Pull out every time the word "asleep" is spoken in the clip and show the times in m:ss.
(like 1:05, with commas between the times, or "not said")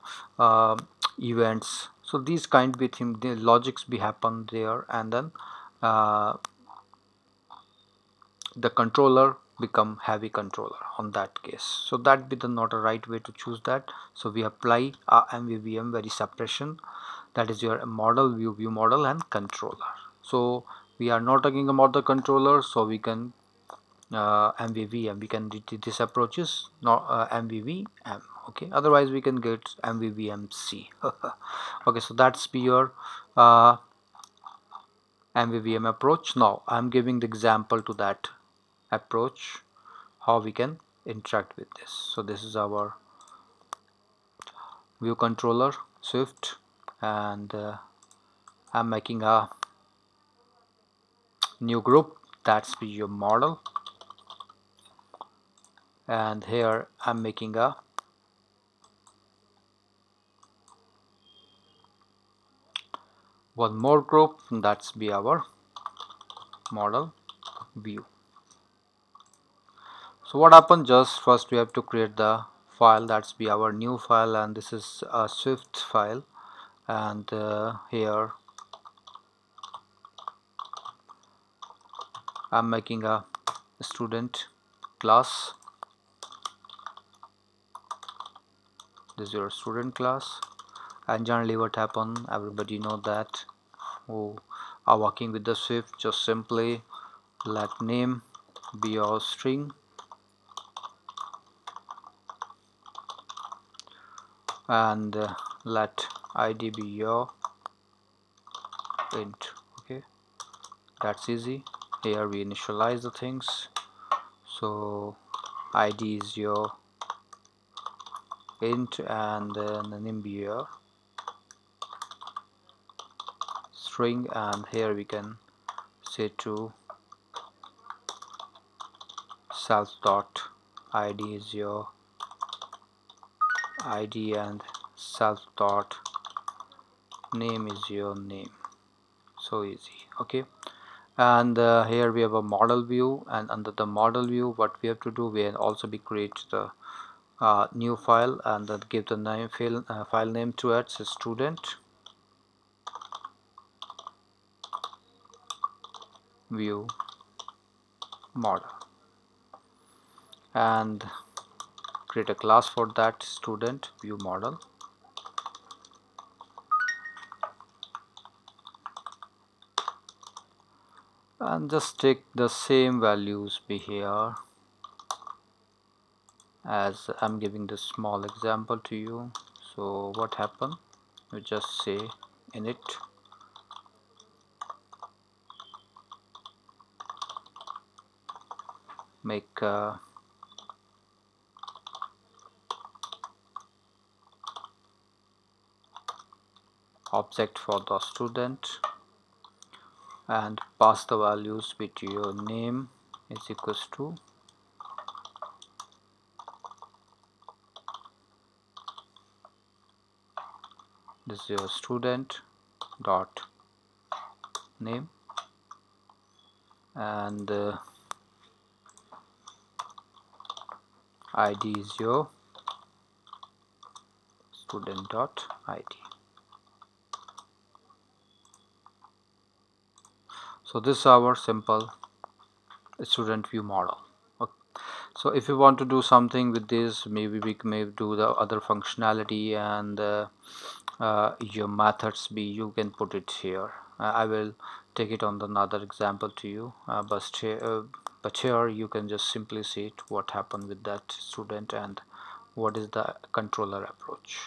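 not said.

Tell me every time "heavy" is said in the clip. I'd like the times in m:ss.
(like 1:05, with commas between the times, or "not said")
0:10.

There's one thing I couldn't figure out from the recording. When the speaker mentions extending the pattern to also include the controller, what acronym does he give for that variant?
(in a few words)
MVVMC.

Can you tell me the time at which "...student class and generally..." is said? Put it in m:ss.
1:29.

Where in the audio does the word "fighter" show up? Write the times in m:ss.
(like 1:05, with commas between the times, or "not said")
not said.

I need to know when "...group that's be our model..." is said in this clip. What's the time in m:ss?
1:04.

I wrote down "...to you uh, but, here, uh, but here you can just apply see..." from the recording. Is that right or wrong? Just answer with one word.
wrong.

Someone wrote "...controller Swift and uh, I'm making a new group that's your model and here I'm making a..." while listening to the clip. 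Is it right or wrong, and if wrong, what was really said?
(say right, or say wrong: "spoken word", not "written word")
right.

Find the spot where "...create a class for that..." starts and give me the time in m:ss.
2:42.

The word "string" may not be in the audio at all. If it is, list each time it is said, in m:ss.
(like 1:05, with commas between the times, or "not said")
1:39, 2:03.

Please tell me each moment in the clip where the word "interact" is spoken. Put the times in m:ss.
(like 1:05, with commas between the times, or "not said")
0:41.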